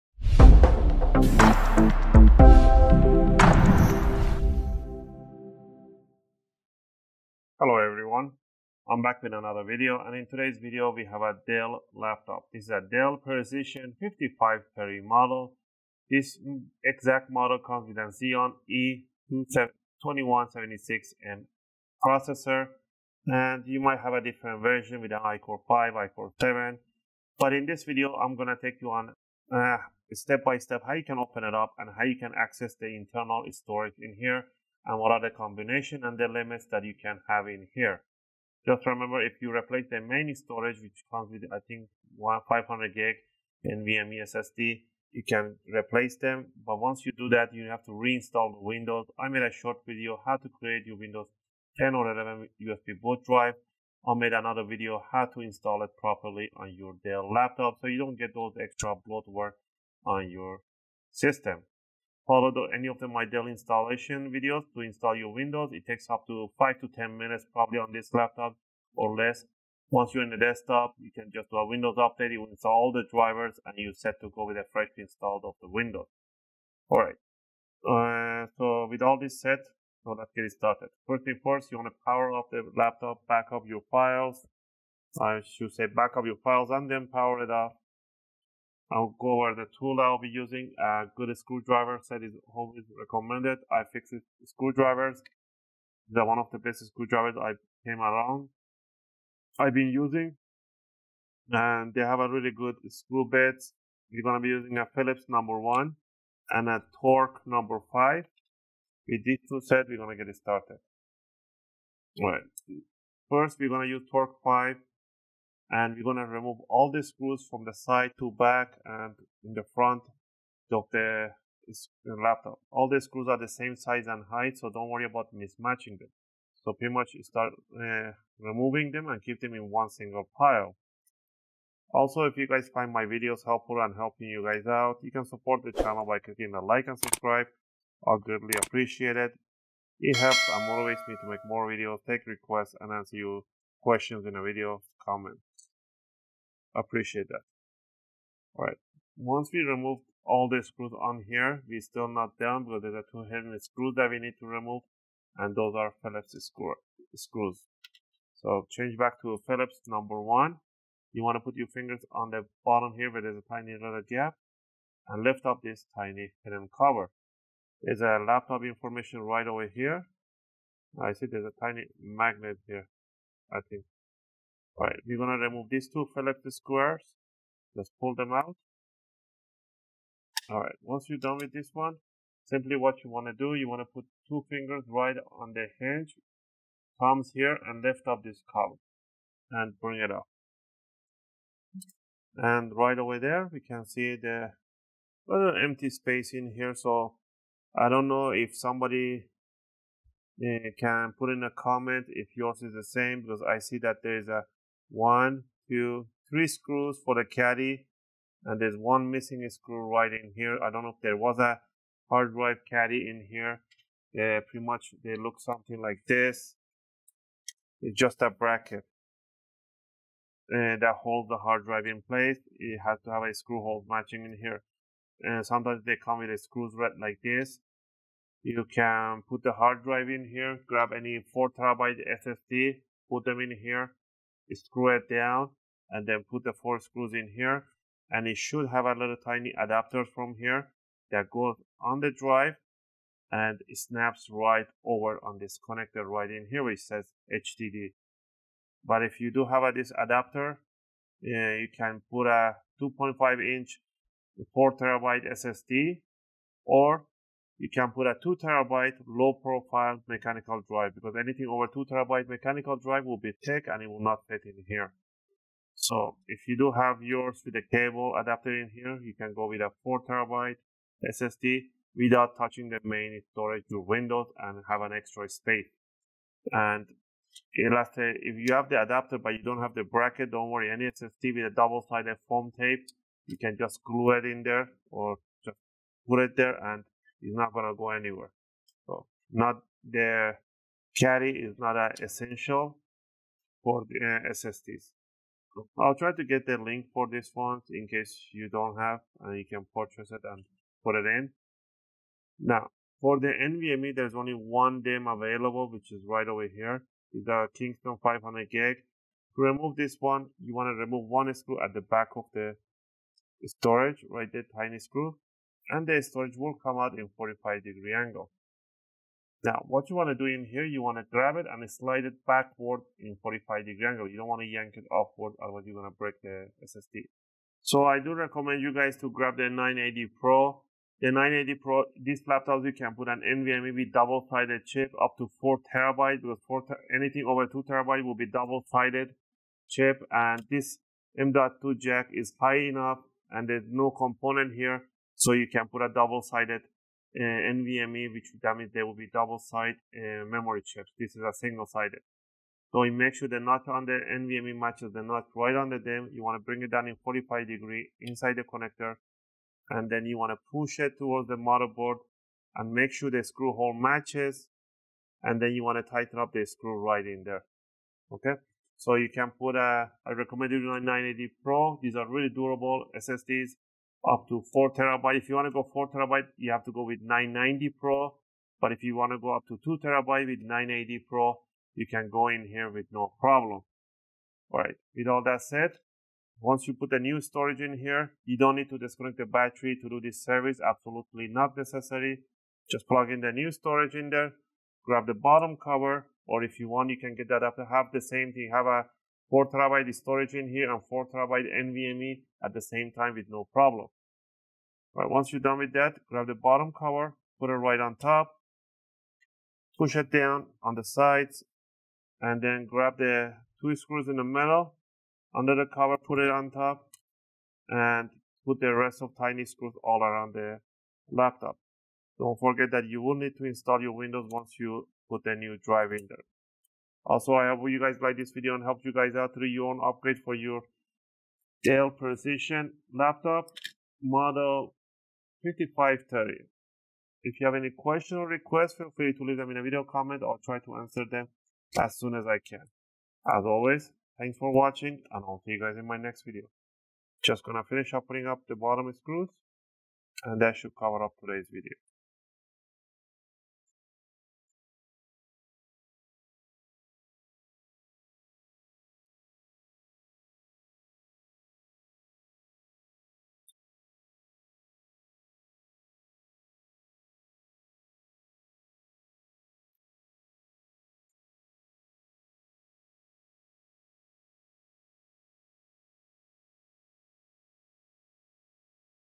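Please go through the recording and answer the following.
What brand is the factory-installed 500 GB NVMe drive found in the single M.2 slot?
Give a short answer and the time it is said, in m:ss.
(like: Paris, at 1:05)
Kingston, at 5:07.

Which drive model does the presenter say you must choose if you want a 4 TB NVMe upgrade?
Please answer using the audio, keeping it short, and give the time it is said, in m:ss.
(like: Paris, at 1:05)
990 Pro, at 6:17.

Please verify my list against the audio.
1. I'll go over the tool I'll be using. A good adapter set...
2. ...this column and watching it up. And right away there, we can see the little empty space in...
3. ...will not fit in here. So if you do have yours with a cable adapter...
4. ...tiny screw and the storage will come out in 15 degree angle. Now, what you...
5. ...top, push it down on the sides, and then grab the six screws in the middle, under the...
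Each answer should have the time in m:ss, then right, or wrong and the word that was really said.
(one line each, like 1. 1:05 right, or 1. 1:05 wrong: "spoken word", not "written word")
1. 1:28 wrong: "screwdriver", not "adapter"
2. 3:08 wrong: "bring", not "watching"
3. 4:23 right
4. 5:14 wrong: "45", not "15"
5. 6:47 wrong: "two", not "six".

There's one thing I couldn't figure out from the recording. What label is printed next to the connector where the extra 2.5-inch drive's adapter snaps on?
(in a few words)
HDD.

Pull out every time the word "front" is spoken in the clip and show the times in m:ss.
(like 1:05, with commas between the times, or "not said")
1:59.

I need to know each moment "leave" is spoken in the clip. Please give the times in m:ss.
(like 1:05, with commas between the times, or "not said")
7:19.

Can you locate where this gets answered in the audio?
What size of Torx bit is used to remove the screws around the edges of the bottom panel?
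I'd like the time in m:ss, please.
1:47.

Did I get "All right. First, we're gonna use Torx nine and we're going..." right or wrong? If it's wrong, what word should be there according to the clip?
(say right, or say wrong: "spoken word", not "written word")
wrong: "five", not "nine".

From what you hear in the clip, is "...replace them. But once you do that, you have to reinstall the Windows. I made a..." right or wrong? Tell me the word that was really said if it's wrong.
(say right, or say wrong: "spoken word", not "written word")
right.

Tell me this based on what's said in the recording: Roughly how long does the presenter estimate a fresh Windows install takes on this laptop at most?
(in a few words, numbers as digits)
10 minutes.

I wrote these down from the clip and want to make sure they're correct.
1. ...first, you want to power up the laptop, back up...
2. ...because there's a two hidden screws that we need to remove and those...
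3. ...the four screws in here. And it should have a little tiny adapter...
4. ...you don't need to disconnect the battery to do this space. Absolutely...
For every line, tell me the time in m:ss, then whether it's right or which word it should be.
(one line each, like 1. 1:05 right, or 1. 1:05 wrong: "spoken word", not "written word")
1. 1:21 right
2. 2:32 right
3. 3:56 right
4. 6:28 wrong: "service", not "space".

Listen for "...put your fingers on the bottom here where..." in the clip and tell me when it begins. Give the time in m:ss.
2:41.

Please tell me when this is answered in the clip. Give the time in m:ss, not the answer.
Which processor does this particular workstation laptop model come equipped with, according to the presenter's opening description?
0:18.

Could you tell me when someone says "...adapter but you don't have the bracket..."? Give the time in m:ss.
4:38.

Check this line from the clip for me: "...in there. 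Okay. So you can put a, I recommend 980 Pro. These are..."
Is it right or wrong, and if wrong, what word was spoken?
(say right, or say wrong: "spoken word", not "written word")
right.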